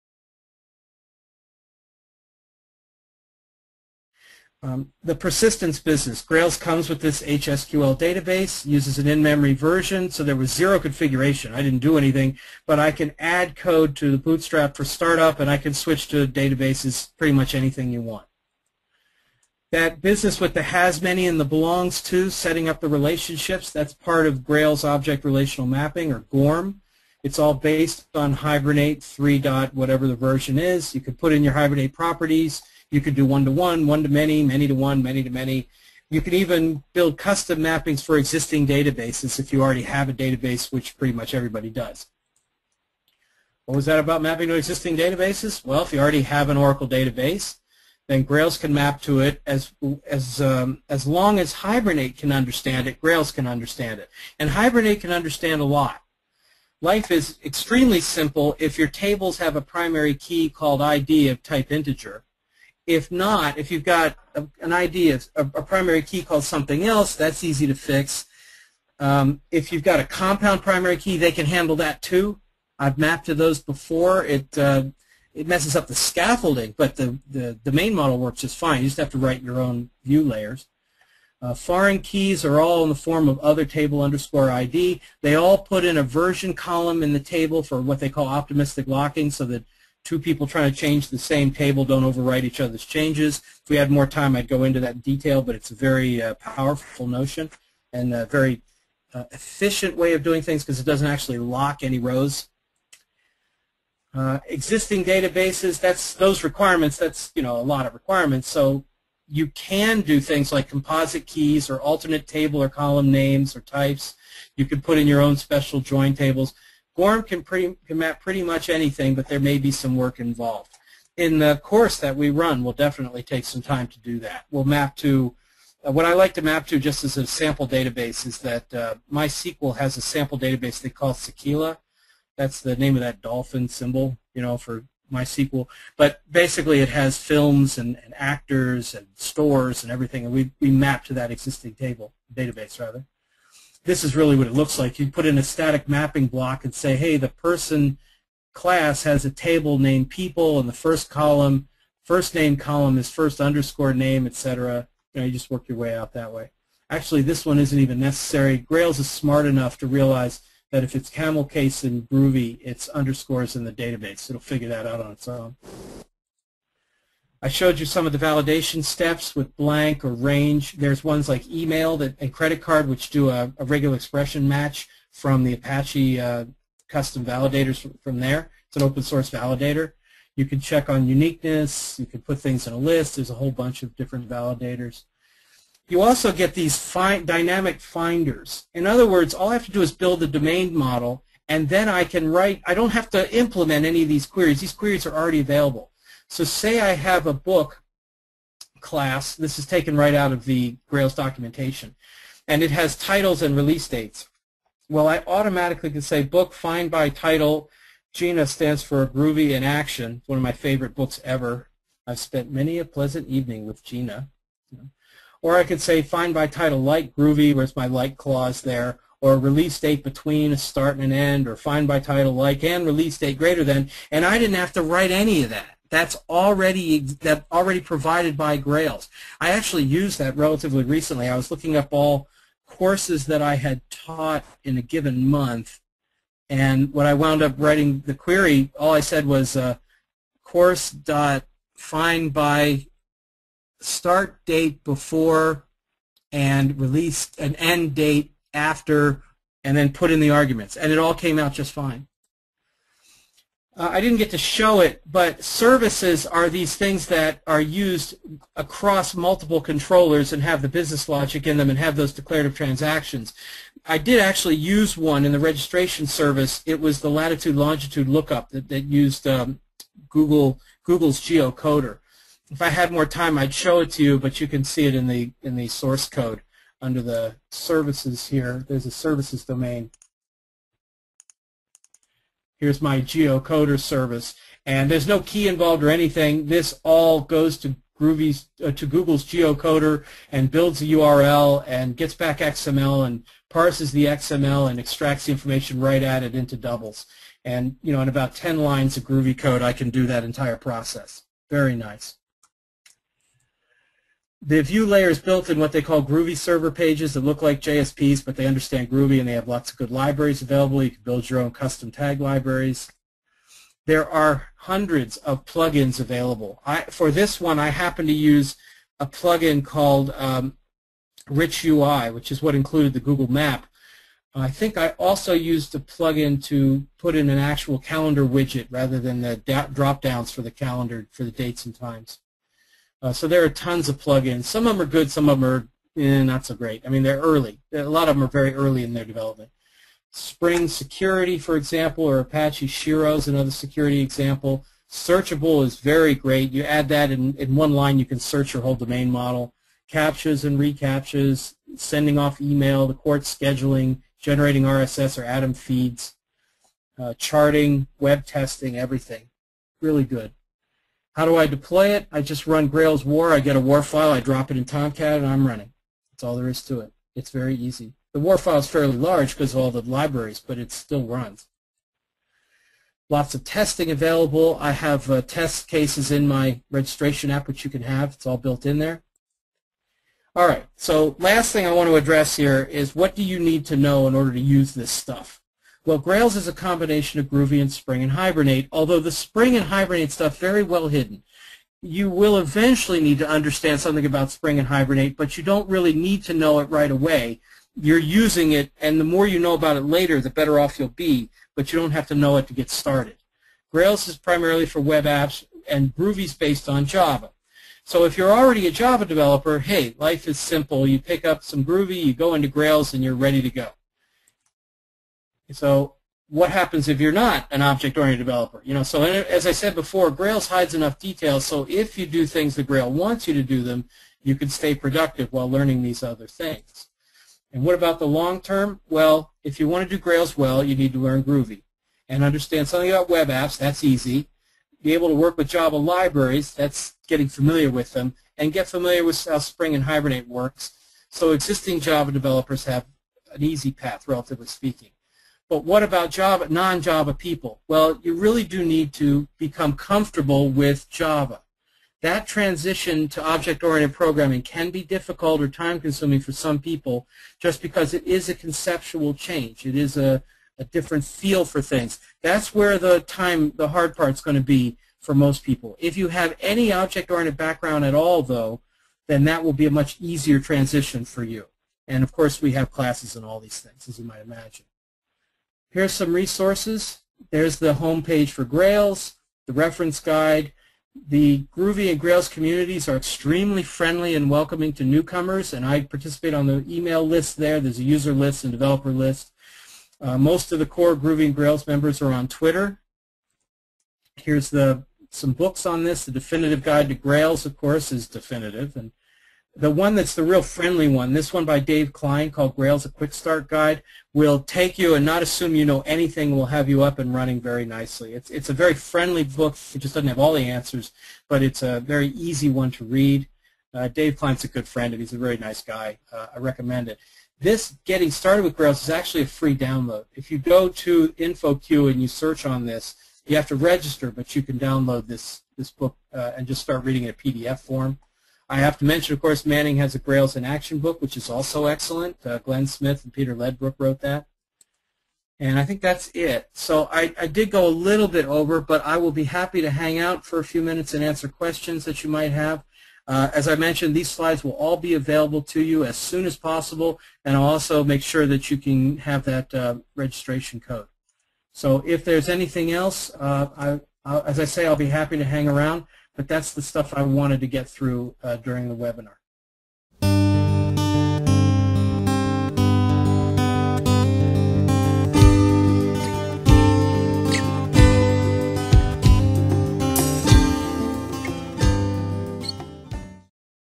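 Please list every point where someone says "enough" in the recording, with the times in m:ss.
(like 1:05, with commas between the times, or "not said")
2:39, 7:00.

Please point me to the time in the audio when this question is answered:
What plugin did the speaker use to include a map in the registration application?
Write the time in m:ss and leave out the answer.
5:21.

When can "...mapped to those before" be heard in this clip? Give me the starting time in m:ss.
1:12.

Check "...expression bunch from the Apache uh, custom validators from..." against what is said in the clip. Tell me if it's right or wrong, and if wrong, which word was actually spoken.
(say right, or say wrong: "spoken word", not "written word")
wrong: "match", not "bunch".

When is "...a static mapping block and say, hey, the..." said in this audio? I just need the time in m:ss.
2:25.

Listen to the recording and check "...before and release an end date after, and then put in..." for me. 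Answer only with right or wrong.
right.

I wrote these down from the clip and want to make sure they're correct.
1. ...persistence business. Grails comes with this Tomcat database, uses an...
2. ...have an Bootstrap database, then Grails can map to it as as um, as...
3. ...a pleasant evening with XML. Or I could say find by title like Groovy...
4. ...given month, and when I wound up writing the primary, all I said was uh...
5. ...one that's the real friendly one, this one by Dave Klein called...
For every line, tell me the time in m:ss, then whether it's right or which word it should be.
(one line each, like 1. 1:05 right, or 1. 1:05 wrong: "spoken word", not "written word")
1. 0:05 wrong: "HSQL", not "Tomcat"
2. 0:46 wrong: "Oracle", not "Bootstrap"
3. 3:32 wrong: "GINA", not "XML"
4. 3:54 wrong: "query", not "primary"
5. 8:19 right.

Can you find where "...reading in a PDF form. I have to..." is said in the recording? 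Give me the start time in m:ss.
8:46.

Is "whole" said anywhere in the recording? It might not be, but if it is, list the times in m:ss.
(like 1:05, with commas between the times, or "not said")
3:03, 5:48.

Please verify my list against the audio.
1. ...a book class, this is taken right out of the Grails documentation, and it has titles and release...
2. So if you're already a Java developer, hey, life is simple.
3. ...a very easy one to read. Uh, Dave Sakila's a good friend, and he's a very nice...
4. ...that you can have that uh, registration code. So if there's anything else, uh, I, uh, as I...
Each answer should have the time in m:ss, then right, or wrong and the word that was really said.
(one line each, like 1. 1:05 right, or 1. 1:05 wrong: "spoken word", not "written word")
1. 3:17 right
2. 6:47 right
3. 8:31 wrong: "Klein", not "Sakila"
4. 9:08 right.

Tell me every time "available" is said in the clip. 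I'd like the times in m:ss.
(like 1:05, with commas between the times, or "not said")
3:15, 5:10, 5:15, 6:13, 9:04.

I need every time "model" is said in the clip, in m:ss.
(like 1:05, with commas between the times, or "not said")
1:17, 3:10, 5:49.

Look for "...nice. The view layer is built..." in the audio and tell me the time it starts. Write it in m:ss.
5:01.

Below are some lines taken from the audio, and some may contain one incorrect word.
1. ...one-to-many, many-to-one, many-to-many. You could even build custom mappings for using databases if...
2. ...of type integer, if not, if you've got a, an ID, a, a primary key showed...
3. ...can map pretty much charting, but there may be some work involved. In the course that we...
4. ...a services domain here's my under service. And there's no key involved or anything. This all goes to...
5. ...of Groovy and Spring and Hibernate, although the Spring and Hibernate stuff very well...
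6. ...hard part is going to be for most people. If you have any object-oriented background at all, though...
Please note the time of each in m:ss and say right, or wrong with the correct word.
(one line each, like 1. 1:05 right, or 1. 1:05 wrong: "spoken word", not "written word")
1. 0:33 wrong: "existing", not "using"
2. 1:01 wrong: "called", not "showed"
3. 1:57 wrong: "anything", not "charting"
4. 4:38 wrong: "geocoder", not "under"
5. 6:27 right
6. 7:43 right.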